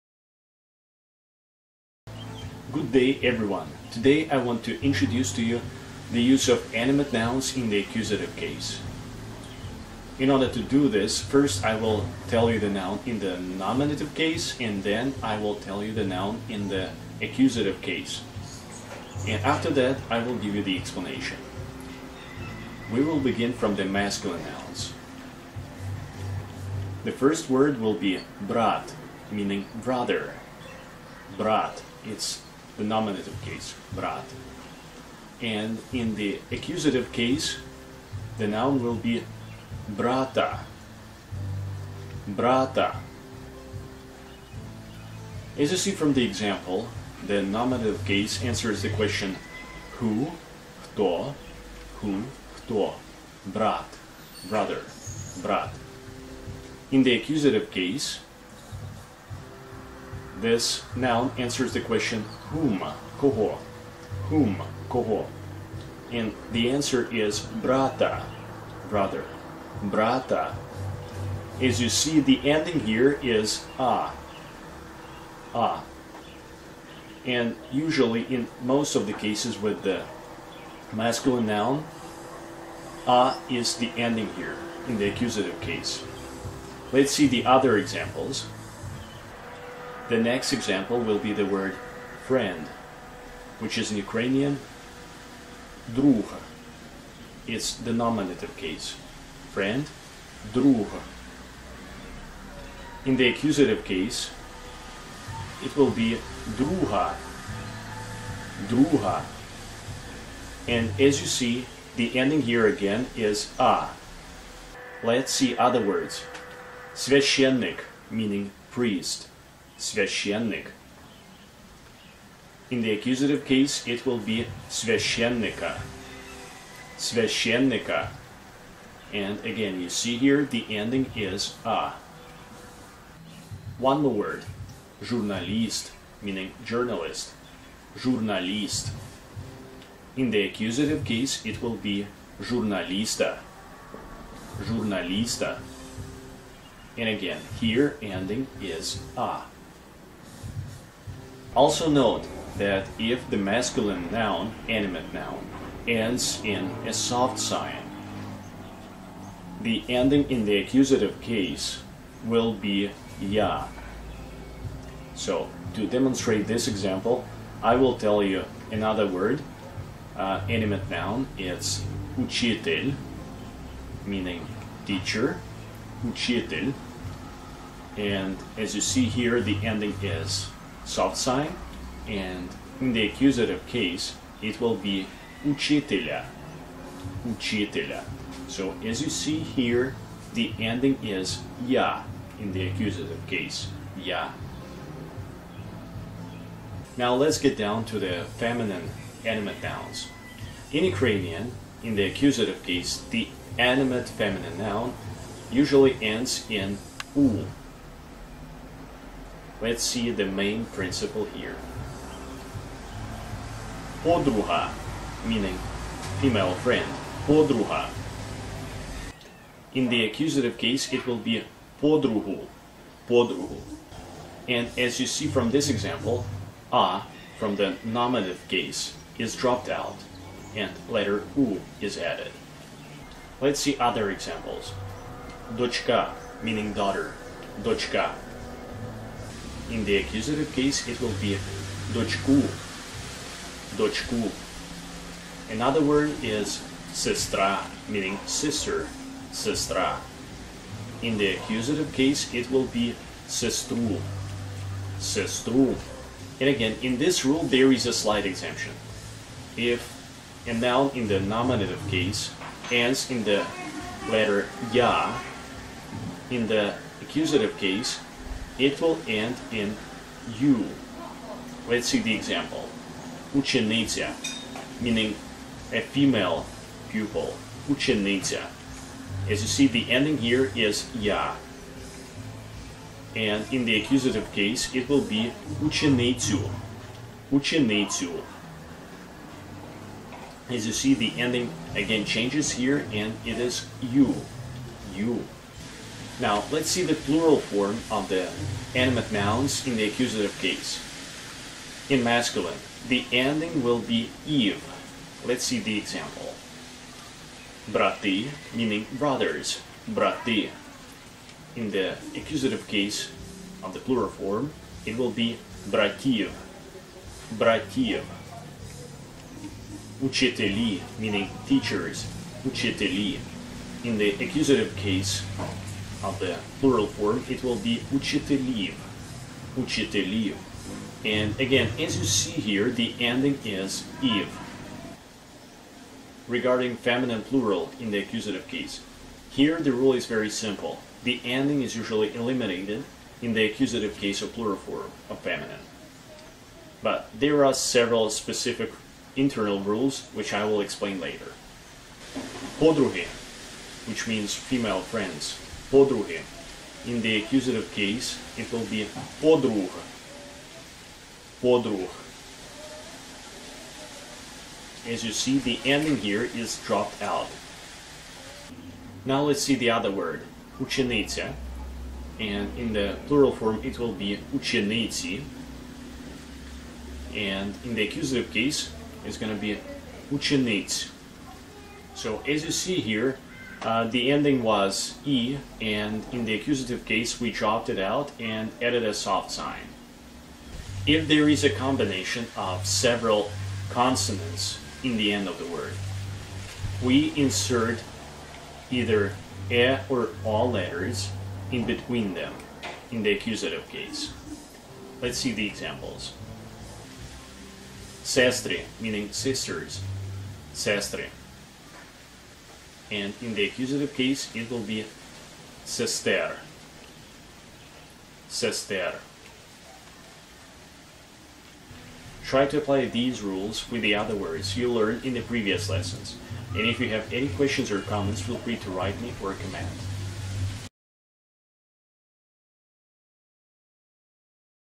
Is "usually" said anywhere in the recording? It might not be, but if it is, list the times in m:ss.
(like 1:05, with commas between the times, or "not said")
1:17, 3:25, 5:41.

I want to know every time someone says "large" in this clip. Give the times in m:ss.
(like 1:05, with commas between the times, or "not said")
not said.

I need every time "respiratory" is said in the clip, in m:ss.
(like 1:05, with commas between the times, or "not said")
not said.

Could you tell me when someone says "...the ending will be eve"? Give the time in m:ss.
5:02.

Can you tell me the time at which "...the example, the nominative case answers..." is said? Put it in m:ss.
0:46.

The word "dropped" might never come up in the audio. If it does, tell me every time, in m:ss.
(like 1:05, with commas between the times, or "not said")
3:49, 6:06, 6:27.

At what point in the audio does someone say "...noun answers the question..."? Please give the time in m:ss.
1:00.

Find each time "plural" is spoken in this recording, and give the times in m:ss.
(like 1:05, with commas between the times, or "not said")
4:56, 5:13, 5:26, 5:37, 5:44, 6:13.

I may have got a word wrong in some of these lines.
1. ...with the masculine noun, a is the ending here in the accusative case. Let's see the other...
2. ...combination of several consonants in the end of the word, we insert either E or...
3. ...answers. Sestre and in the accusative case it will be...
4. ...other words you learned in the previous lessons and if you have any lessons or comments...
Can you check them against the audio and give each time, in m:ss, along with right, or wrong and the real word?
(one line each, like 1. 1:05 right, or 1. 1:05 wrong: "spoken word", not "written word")
1. 1:19 right
2. 6:31 right
3. 6:49 wrong: "sisters", not "answers"
4. 7:03 wrong: "questions", not "lessons".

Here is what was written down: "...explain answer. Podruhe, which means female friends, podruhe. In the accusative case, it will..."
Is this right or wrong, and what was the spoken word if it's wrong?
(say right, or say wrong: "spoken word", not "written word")
wrong: "later", not "answer".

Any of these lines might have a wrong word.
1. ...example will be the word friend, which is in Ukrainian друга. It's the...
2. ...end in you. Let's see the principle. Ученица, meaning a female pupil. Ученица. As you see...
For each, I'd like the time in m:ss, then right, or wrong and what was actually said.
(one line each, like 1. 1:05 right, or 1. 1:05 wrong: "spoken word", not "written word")
1. 1:30 right
2. 4:29 wrong: "example", not "principle".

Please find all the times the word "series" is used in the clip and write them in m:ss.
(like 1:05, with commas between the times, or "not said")
not said.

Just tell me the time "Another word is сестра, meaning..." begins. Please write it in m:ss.
4:05.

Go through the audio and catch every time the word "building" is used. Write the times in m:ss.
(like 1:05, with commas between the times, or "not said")
not said.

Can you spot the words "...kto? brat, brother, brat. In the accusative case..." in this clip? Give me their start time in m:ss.
0:52.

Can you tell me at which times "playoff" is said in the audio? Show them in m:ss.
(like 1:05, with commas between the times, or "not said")
not said.